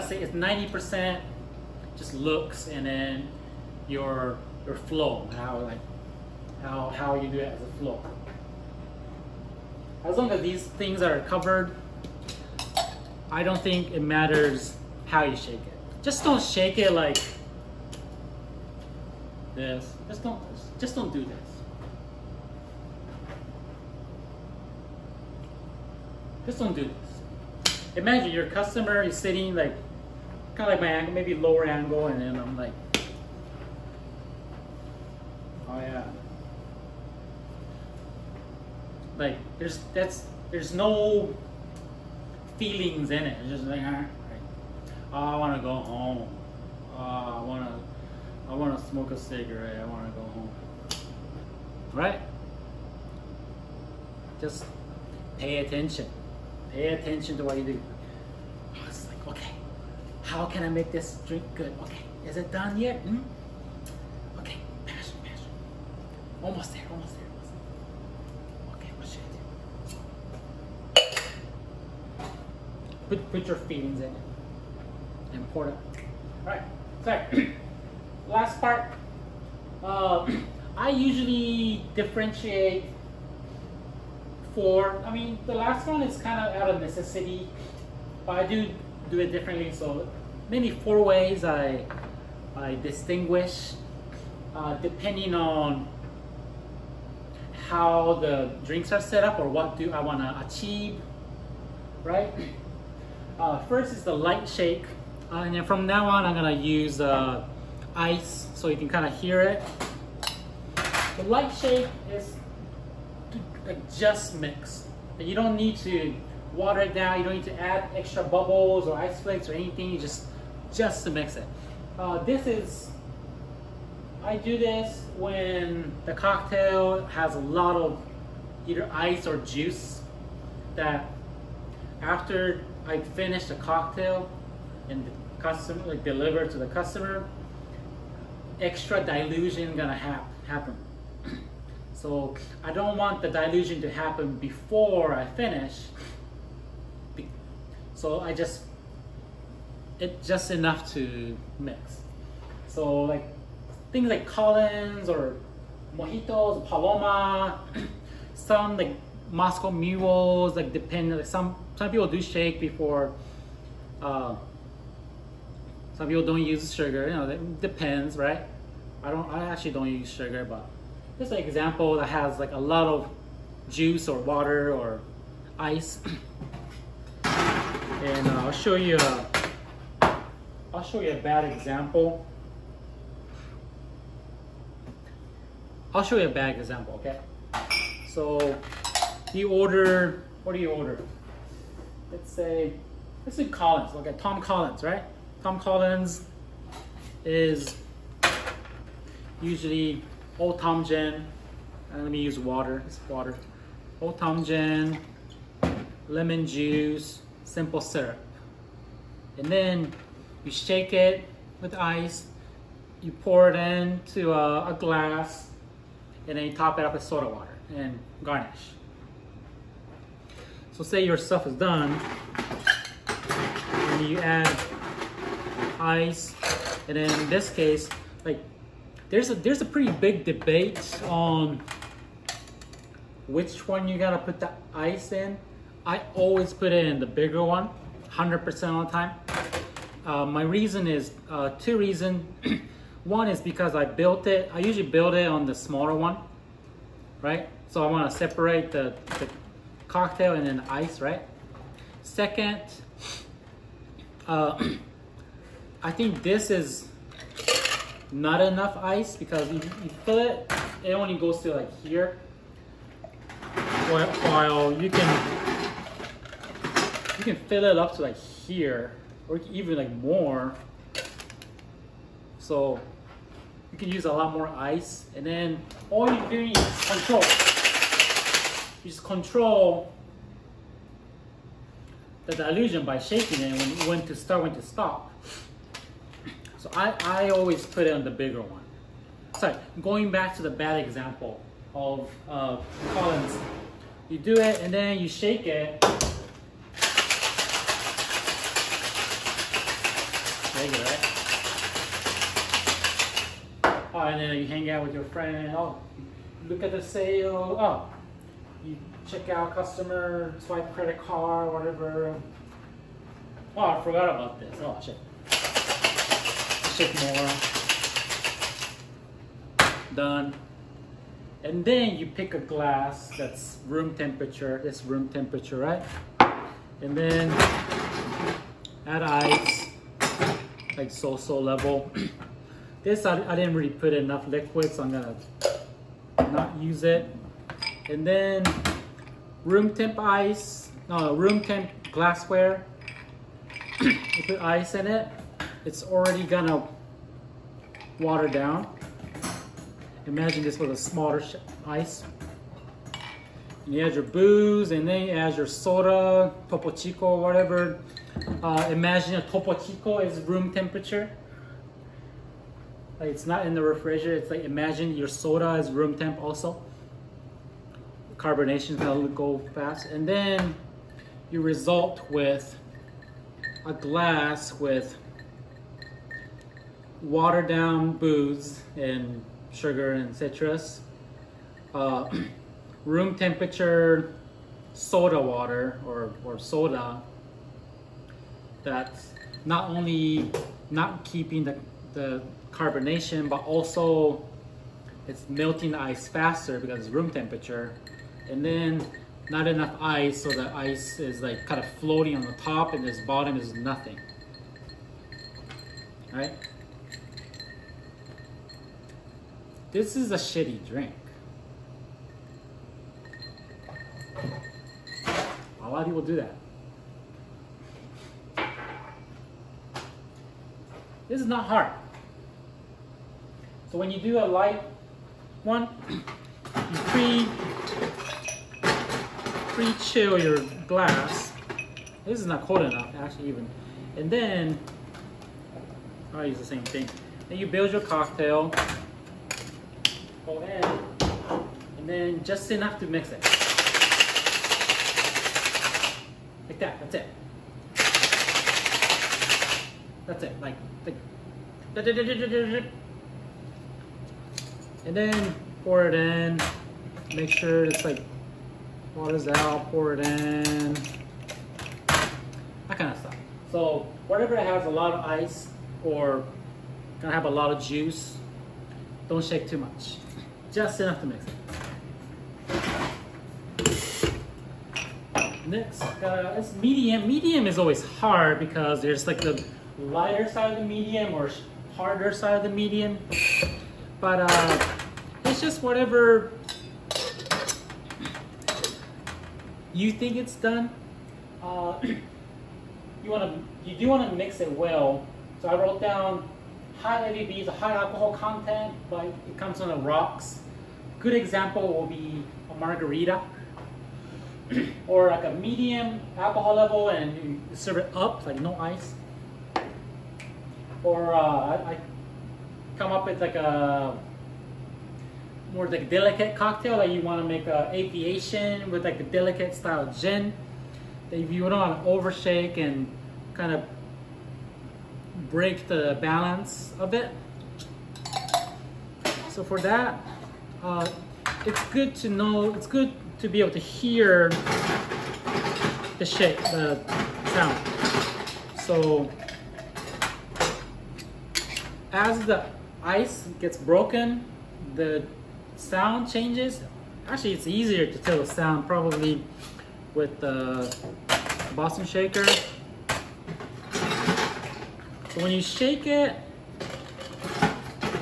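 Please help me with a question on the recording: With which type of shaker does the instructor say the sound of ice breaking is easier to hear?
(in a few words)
Boston shaker.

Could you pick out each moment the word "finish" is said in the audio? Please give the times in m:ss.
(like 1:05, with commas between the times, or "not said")
2:12, 2:25.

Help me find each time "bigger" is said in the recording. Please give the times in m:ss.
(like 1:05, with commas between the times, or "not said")
3:57, 4:48.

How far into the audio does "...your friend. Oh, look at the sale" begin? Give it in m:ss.
5:04.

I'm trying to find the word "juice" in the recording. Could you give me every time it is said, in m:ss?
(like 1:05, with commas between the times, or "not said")
2:09, 2:53, 3:26, 7:47.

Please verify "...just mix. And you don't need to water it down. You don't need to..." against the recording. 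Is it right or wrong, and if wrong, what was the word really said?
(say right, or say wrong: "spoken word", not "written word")
right.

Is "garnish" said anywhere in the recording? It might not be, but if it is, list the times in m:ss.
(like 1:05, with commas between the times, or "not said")
3:38.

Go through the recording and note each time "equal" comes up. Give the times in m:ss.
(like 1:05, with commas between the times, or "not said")
not said.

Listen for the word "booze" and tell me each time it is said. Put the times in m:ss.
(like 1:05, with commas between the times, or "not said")
5:54, 6:17.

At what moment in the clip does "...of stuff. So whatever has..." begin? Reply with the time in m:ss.
7:42.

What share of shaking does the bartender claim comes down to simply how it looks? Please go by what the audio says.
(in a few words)
90%.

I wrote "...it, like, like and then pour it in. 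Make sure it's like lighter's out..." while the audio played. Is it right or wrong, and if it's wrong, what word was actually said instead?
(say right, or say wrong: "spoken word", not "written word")
wrong: "water", not "lighter".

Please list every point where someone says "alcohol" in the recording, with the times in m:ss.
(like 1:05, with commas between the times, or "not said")
8:17, 8:26.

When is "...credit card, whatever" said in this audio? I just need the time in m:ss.
5:10.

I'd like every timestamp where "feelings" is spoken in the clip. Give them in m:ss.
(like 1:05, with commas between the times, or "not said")
0:42, 1:13.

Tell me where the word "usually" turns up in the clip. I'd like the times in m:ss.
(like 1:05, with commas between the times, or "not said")
1:20, 3:19, 4:04.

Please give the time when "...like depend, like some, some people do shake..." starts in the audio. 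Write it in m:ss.
2:40.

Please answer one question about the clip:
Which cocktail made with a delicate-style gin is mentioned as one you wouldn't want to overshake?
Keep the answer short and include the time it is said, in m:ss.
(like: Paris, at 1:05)
aviation, at 8:37.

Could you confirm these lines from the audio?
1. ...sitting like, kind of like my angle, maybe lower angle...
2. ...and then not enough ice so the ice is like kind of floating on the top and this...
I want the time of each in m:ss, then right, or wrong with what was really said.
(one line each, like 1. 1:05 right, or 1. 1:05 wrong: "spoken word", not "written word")
1. 0:29 right
2. 6:38 right.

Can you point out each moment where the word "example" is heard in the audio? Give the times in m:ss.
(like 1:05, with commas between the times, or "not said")
2:51, 3:01, 3:06, 4:50, 8:21.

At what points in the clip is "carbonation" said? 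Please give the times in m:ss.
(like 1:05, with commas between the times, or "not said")
6:08, 6:32.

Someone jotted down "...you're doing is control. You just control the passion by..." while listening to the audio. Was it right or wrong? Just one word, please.
wrong.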